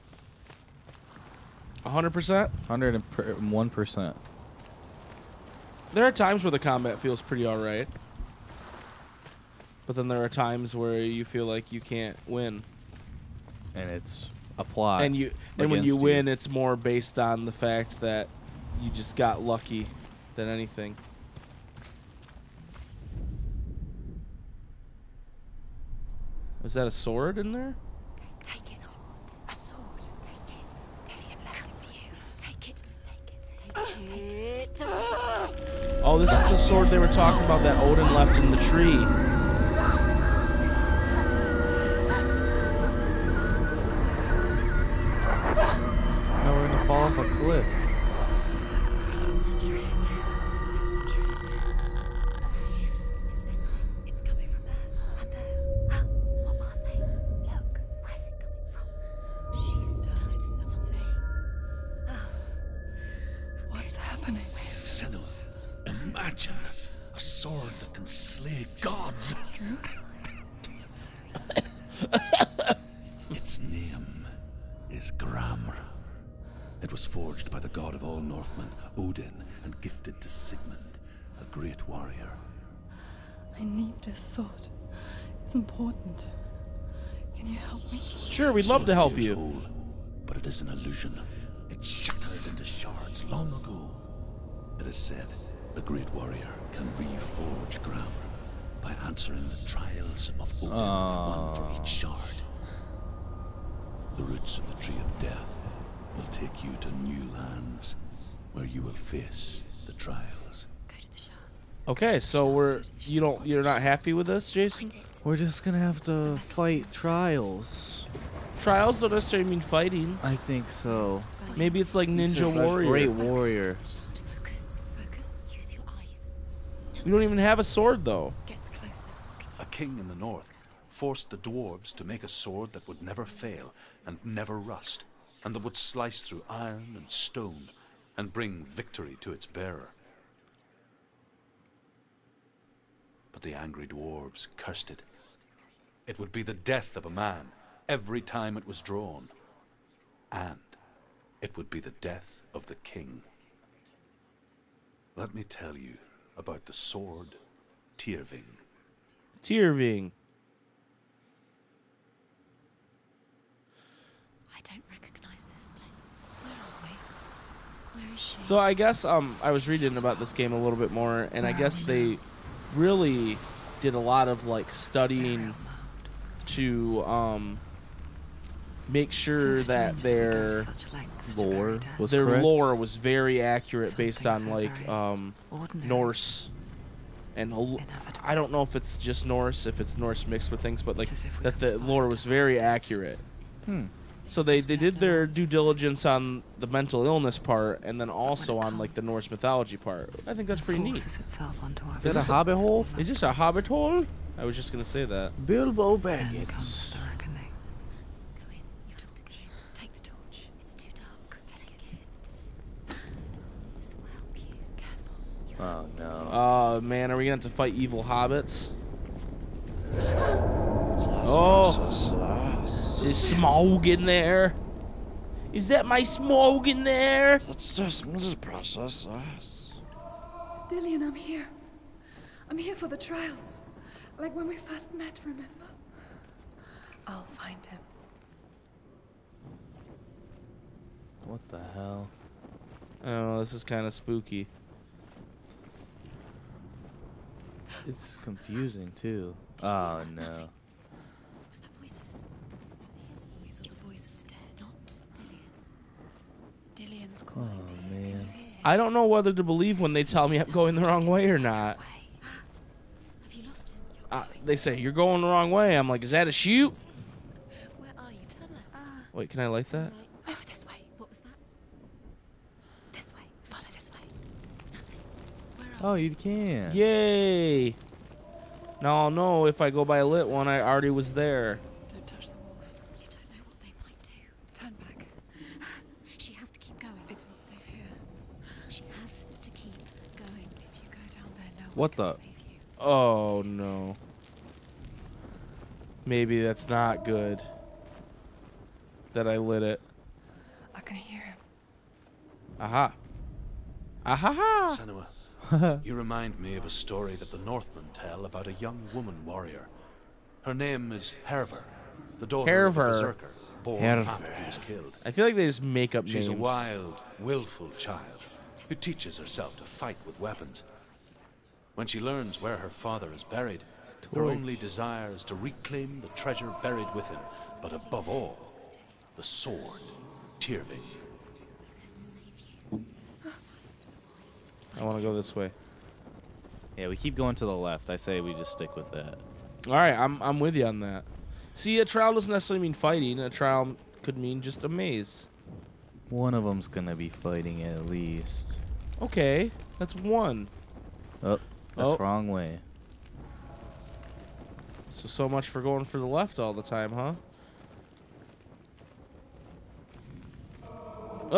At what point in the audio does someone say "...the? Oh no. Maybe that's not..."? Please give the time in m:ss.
4:51.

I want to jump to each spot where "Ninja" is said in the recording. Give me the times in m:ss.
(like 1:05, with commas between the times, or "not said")
2:02.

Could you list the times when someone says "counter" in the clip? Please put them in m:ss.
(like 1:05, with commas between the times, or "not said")
not said.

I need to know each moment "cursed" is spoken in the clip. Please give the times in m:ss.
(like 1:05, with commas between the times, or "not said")
2:24.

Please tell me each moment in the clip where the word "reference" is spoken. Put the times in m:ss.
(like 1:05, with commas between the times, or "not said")
not said.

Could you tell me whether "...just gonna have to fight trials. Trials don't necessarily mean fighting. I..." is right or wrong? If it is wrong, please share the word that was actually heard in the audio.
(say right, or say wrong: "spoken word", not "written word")
right.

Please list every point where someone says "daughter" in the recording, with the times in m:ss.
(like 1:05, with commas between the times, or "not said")
5:12.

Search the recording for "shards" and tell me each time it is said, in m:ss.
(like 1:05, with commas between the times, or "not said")
1:32, 1:41.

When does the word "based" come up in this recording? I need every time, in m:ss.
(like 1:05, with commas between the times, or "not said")
0:16, 3:03.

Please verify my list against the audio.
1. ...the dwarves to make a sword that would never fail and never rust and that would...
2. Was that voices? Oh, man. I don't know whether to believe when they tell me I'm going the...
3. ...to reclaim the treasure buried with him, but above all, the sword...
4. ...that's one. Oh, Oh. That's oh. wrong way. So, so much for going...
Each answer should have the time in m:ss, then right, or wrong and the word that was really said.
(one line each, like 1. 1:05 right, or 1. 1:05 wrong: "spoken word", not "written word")
1. 2:11 right
2. 4:11 right
3. 5:25 right
4. 5:49 right.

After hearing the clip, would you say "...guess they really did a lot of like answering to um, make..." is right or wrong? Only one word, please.
wrong.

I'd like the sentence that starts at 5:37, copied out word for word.
I say we just stick with that.